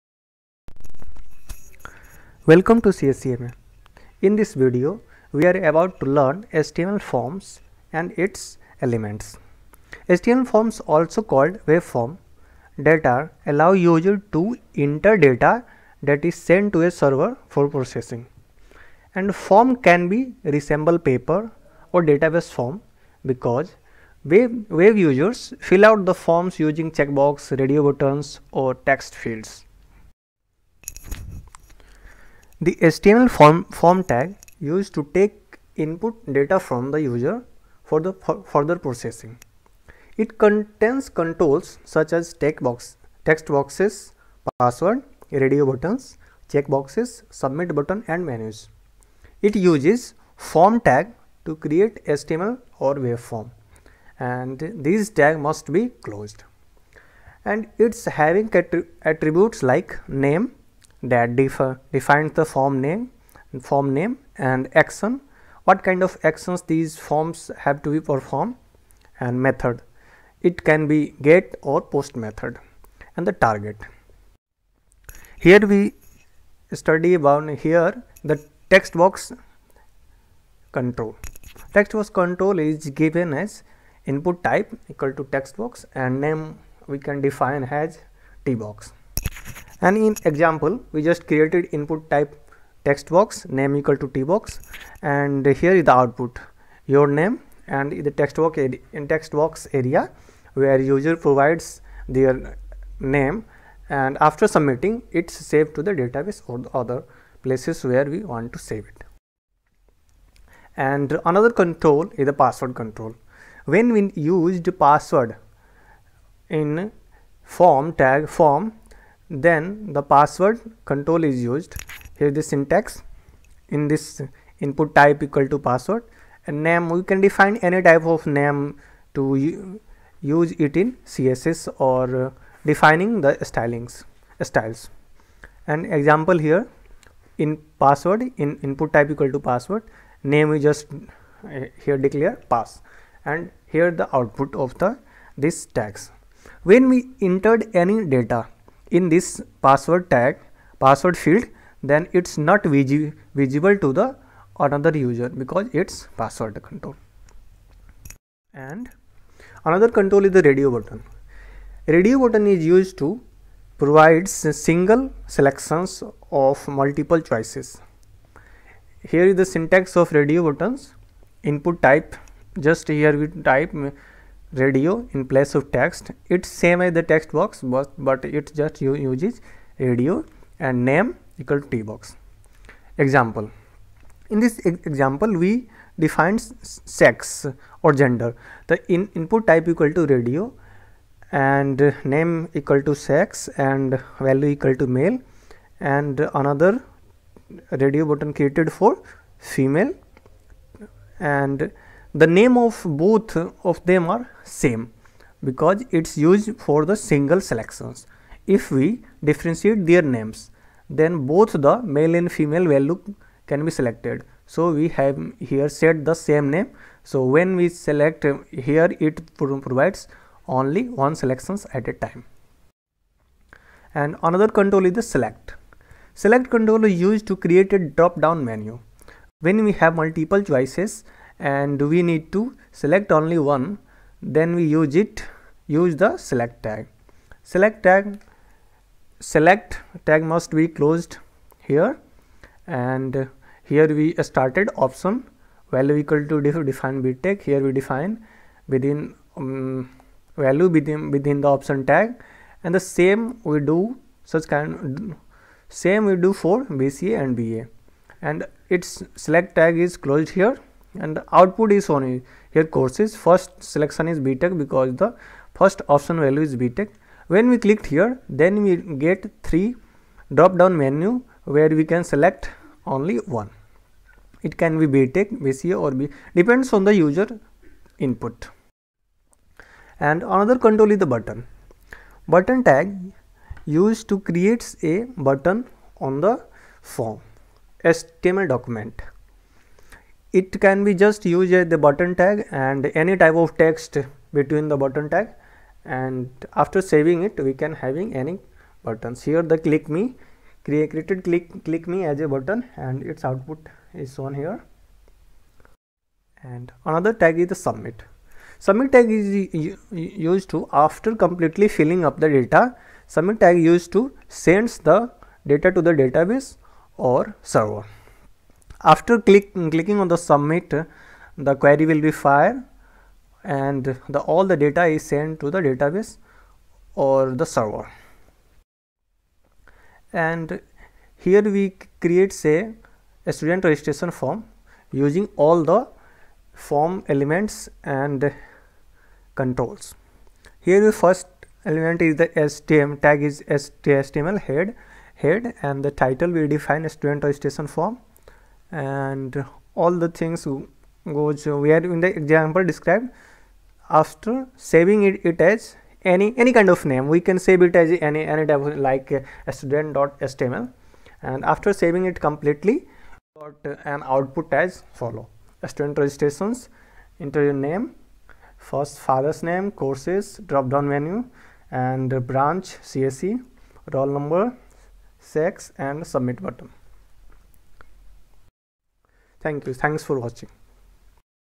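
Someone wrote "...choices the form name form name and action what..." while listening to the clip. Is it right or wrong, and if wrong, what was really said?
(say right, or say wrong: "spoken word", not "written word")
wrong: "defines", not "choices".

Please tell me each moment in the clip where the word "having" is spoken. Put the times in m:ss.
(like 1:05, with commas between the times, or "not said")
0:58, 4:57.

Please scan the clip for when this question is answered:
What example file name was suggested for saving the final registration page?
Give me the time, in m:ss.
5:59.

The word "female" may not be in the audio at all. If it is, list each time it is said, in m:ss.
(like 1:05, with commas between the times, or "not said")
3:19, 3:32.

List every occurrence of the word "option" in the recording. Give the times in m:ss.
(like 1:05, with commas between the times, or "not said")
4:04, 4:11, 4:25.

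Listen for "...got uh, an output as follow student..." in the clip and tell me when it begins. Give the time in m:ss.
6:03.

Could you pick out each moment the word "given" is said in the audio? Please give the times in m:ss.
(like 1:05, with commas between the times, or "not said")
1:22.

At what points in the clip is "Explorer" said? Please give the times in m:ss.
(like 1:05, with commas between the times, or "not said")
not said.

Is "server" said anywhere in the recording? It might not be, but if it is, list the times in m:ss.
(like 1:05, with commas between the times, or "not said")
0:16, 5:17, 5:27.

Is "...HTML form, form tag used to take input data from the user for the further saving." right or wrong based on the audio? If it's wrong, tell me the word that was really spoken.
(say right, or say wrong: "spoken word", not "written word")
wrong: "processing", not "saving".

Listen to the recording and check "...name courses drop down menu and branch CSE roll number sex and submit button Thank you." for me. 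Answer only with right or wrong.
right.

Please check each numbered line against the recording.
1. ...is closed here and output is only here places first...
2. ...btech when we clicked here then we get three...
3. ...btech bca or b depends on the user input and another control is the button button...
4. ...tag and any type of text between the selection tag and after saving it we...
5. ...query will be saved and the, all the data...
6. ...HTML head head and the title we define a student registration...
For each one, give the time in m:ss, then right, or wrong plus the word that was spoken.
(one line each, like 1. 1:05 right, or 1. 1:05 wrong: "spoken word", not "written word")
1. 4:19 wrong: "courses", not "places"
2. 4:26 right
3. 4:34 right
4. 4:52 wrong: "button", not "selection"
5. 5:21 wrong: "fired", not "saved"
6. 5:43 right.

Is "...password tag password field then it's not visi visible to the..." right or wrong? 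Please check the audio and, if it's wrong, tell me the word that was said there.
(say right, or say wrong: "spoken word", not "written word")
right.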